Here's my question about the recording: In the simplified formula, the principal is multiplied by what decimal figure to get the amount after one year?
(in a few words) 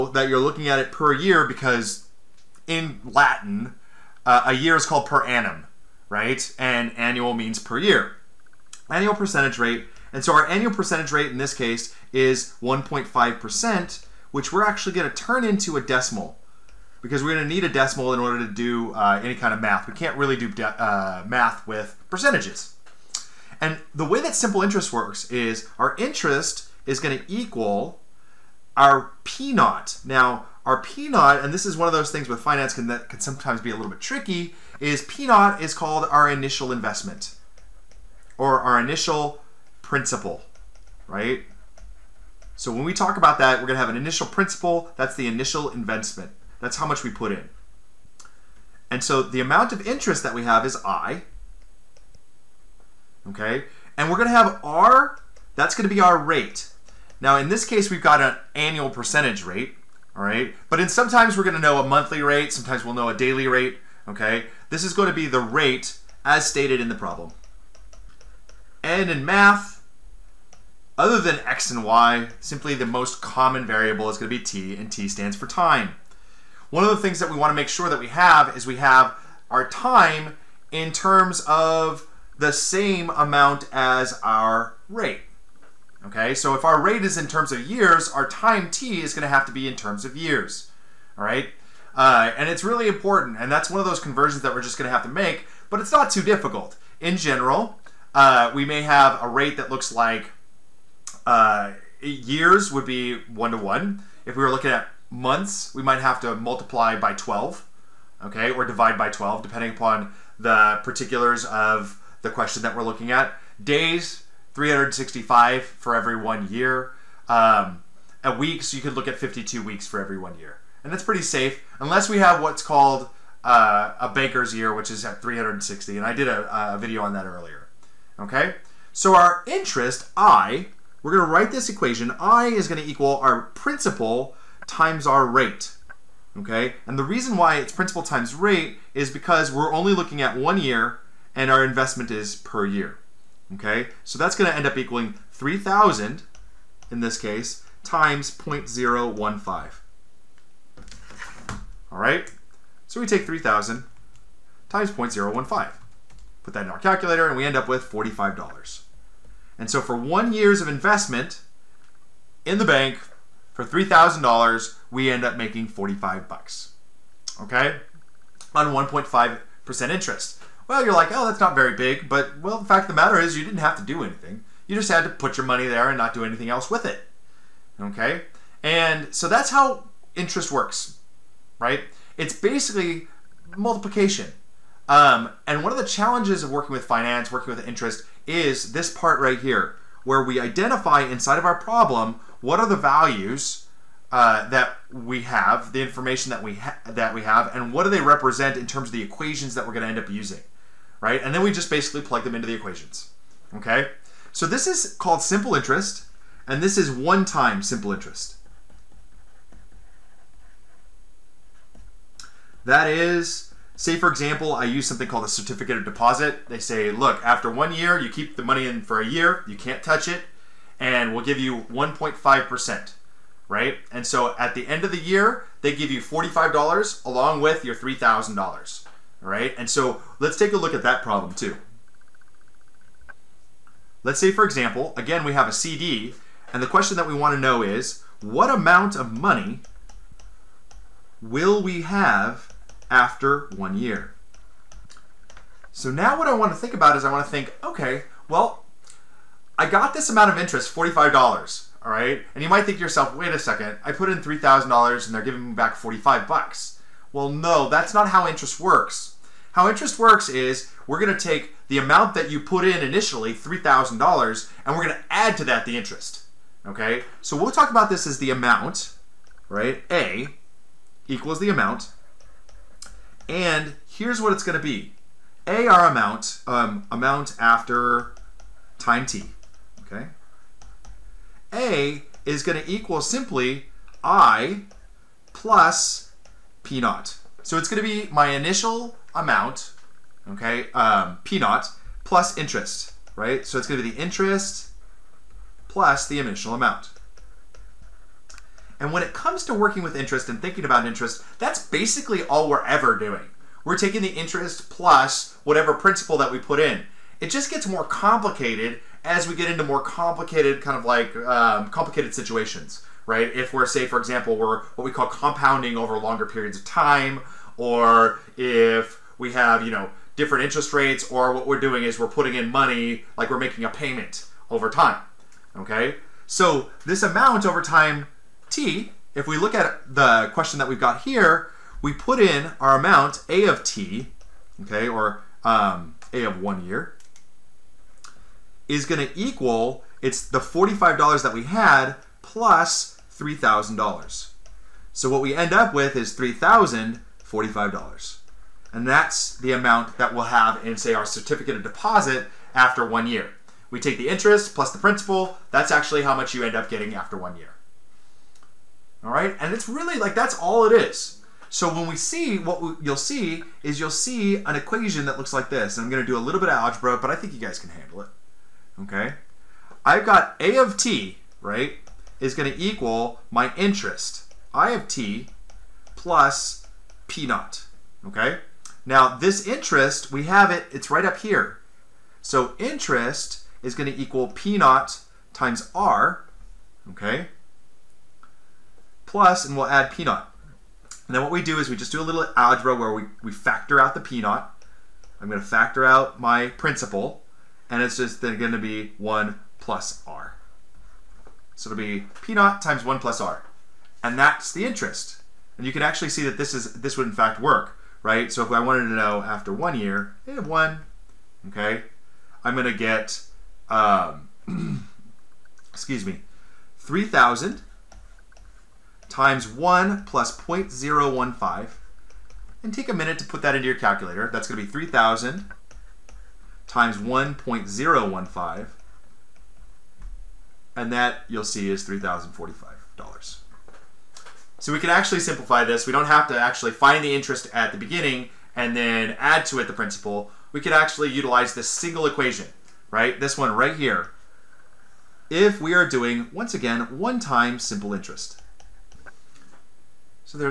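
1.015.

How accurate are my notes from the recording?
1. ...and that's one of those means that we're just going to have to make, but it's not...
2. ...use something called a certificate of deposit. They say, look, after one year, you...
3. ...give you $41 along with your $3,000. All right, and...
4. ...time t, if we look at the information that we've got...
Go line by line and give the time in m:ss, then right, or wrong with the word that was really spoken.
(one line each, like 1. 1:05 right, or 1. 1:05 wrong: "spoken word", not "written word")
1. 1:33 wrong: "conversions", not "means"
2. 3:34 right
3. 3:45 wrong: "45", not "41"
4. 5:27 wrong: "question", not "information".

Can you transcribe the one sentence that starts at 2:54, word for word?
You just had to put your money there and not do anything else with it.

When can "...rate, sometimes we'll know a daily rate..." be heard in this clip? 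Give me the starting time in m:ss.
1:02.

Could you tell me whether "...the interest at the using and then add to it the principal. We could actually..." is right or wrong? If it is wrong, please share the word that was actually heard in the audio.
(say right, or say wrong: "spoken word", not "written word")
wrong: "beginning", not "using".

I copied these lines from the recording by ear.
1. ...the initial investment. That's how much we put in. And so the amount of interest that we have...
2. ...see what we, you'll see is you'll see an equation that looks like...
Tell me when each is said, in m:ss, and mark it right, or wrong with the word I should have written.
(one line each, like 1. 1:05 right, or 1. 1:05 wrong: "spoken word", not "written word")
1. 0:45 right
2. 6:01 right.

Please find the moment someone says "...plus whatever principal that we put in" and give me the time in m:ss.
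5:04.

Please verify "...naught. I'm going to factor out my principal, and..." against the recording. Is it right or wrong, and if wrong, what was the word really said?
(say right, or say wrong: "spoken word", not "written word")
right.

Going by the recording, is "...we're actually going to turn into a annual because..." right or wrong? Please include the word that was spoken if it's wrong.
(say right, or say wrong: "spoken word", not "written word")
wrong: "decimal", not "annual".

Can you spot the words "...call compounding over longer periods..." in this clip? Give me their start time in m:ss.
5:14.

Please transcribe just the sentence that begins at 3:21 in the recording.
And then we just basically plug them into the equations, okay?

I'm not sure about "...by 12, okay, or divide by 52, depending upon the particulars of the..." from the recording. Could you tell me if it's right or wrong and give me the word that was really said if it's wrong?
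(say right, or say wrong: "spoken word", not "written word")
wrong: "12", not "52".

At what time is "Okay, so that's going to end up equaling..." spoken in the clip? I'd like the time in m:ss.
2:23.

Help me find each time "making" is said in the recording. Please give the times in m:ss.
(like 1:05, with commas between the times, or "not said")
2:45, 5:23.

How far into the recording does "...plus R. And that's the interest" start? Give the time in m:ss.
6:42.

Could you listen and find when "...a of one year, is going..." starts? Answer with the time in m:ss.
5:36.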